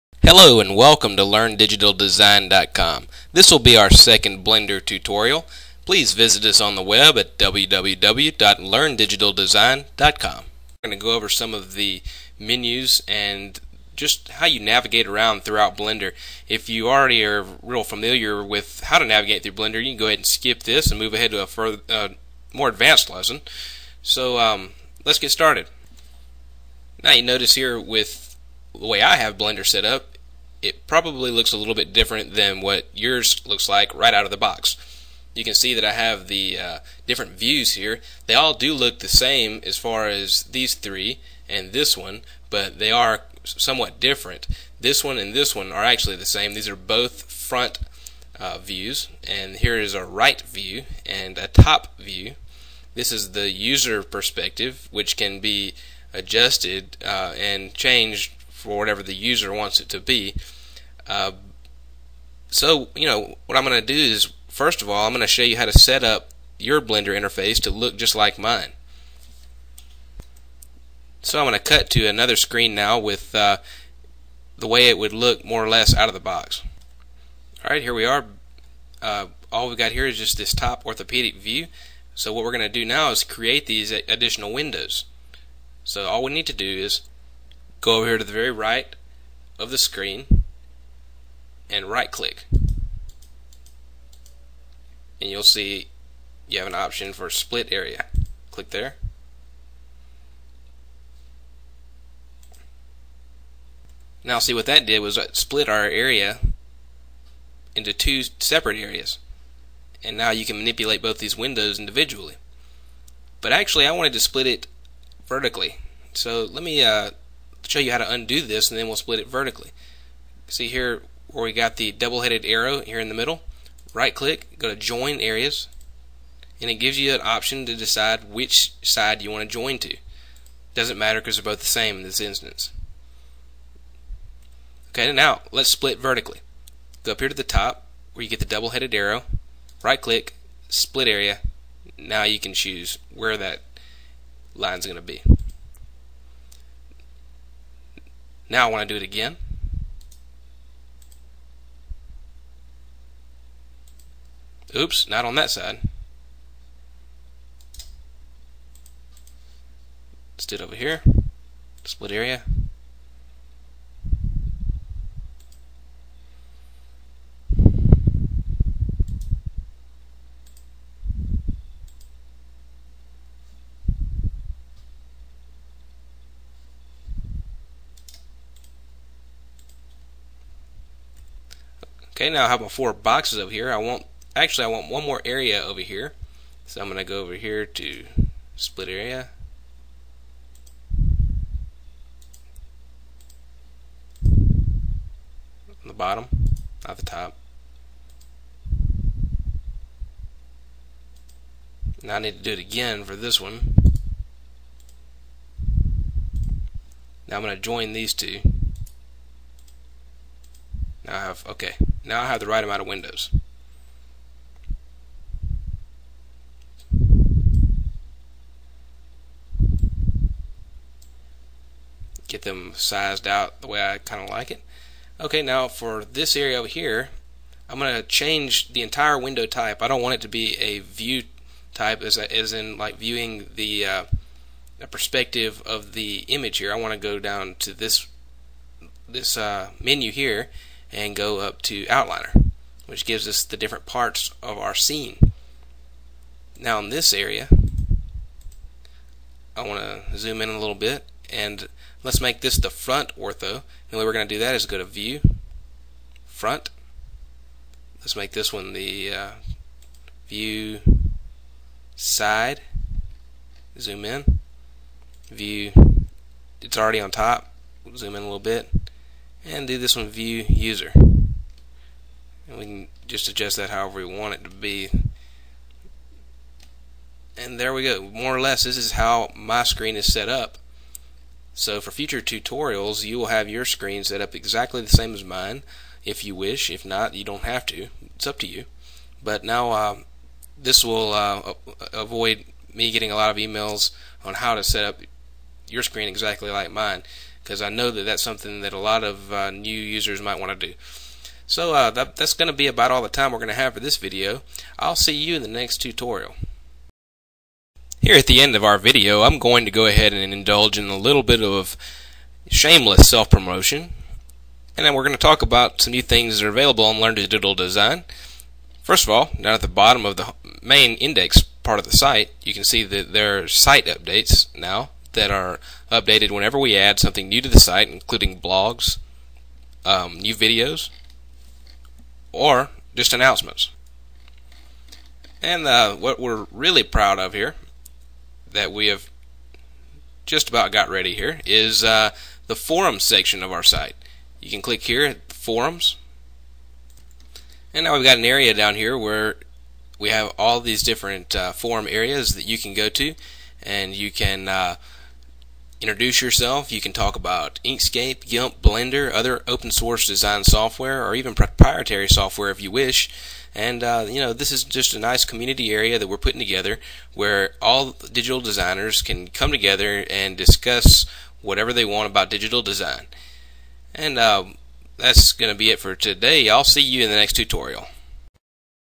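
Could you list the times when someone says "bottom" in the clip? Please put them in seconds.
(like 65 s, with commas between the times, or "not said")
195 s, 319 s.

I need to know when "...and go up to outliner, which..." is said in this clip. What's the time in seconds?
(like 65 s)
240 s.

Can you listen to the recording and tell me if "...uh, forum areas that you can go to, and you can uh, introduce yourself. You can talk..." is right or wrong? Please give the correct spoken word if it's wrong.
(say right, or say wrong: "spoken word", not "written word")
right.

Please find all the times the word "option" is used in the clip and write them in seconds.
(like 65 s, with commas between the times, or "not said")
96 s, 127 s.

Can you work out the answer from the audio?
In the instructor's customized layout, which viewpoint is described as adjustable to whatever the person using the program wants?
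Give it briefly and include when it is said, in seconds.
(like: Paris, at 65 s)
User perspective, at 53 s.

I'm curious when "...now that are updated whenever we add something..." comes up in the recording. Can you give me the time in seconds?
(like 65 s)
324 s.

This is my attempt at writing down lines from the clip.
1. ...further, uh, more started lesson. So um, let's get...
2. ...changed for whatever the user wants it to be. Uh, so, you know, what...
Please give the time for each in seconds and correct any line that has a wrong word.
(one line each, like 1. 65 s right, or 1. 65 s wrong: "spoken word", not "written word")
1. 21 s wrong: "advanced", not "started"
2. 57 s right.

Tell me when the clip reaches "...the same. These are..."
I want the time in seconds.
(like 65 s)
46 s.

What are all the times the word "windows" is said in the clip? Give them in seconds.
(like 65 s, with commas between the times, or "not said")
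84 s, 111 s, 212 s, 229 s.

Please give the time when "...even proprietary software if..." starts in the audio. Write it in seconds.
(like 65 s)
361 s.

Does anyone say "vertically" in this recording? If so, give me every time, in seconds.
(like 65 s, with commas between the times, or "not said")
115 s, 119 s, 135 s.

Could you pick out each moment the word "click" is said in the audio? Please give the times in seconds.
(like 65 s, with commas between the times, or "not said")
92 s, 98 s, 124 s, 140 s, 344 s.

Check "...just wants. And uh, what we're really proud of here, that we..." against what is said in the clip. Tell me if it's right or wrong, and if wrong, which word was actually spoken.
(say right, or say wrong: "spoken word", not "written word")
wrong: "announcements", not "wants".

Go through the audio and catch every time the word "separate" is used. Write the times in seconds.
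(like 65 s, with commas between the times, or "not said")
108 s.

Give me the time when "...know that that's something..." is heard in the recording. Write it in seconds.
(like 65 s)
297 s.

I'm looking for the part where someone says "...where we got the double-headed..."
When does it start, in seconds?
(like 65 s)
121 s.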